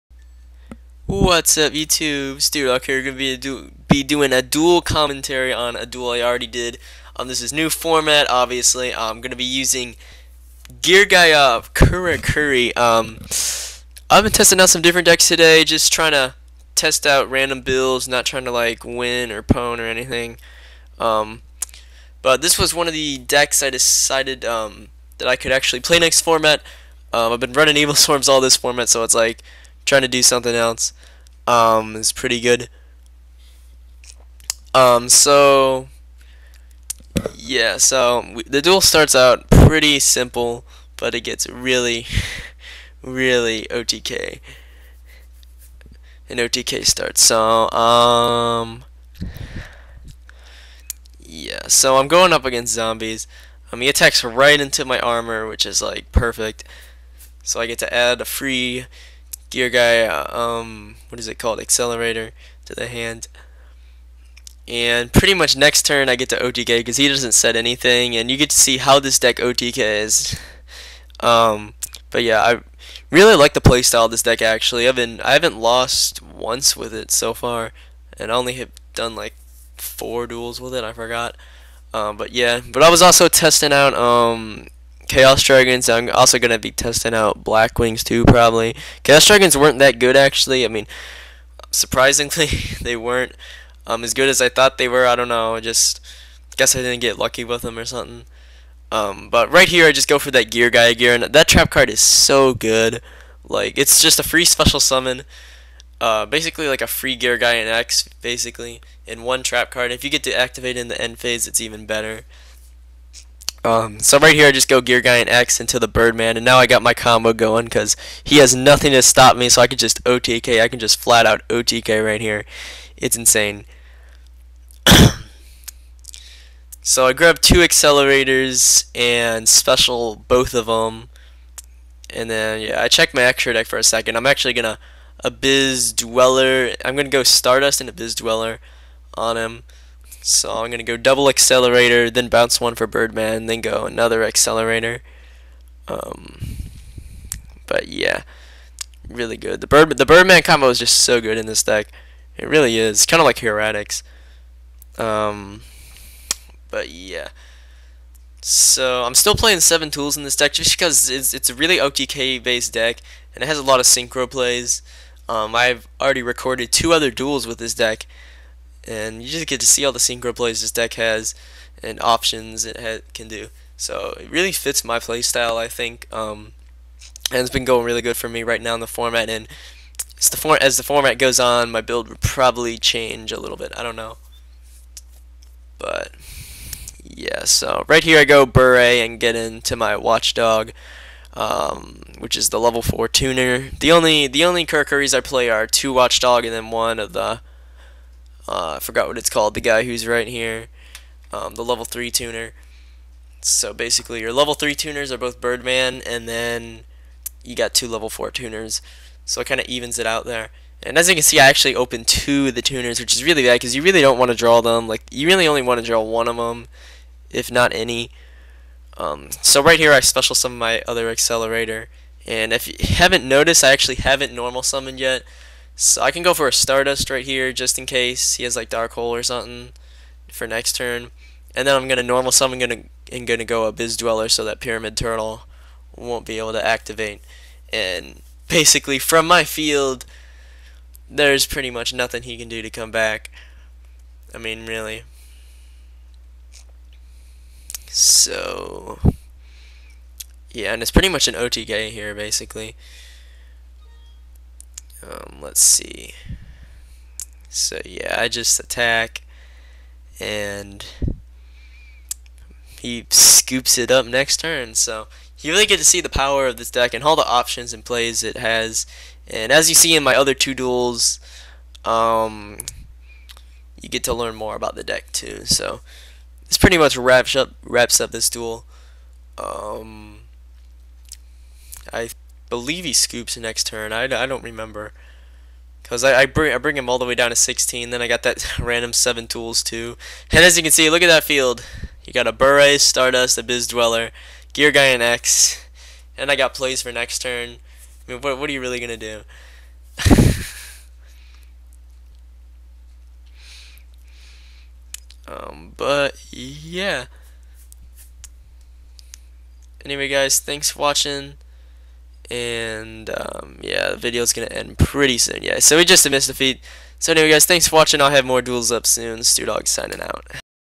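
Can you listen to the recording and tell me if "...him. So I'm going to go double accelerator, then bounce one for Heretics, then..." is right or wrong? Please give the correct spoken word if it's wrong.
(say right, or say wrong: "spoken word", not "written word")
wrong: "Birdman", not "Heretics".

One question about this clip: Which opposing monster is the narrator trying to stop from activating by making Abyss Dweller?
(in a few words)
Pyramid Turtle.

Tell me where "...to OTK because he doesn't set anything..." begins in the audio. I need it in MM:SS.
01:06.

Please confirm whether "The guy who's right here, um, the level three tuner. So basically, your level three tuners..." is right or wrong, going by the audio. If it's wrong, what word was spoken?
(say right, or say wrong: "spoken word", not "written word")
right.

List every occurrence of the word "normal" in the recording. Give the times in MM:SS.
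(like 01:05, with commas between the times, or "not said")
03:44, 03:52.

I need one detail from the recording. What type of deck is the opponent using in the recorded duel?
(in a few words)
Zombies.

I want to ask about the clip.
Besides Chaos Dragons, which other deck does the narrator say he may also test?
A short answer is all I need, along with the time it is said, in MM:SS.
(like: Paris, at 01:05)
Black Wings, at 01:27.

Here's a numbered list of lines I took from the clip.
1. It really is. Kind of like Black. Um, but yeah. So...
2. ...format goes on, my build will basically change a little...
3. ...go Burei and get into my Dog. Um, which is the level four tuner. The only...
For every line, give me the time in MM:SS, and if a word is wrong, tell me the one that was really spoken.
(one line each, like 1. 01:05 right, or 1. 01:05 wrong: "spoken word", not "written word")
1. 02:32 wrong: "Heretics", not "Black"
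2. 03:00 wrong: "probably", not "basically"
3. 03:08 wrong: "Watchdog", not "Dog".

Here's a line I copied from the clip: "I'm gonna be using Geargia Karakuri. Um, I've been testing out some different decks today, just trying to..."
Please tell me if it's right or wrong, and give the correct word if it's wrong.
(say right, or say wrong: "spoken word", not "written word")
right.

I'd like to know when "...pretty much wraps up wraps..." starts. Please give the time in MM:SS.
04:36.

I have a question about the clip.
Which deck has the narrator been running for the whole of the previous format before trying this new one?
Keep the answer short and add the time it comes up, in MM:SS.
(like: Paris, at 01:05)
Evilswarms, at 00:27.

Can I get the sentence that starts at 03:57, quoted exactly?
And basically from my field, there's pretty much nothing he can do to come back.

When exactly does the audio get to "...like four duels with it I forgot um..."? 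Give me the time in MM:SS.
01:19.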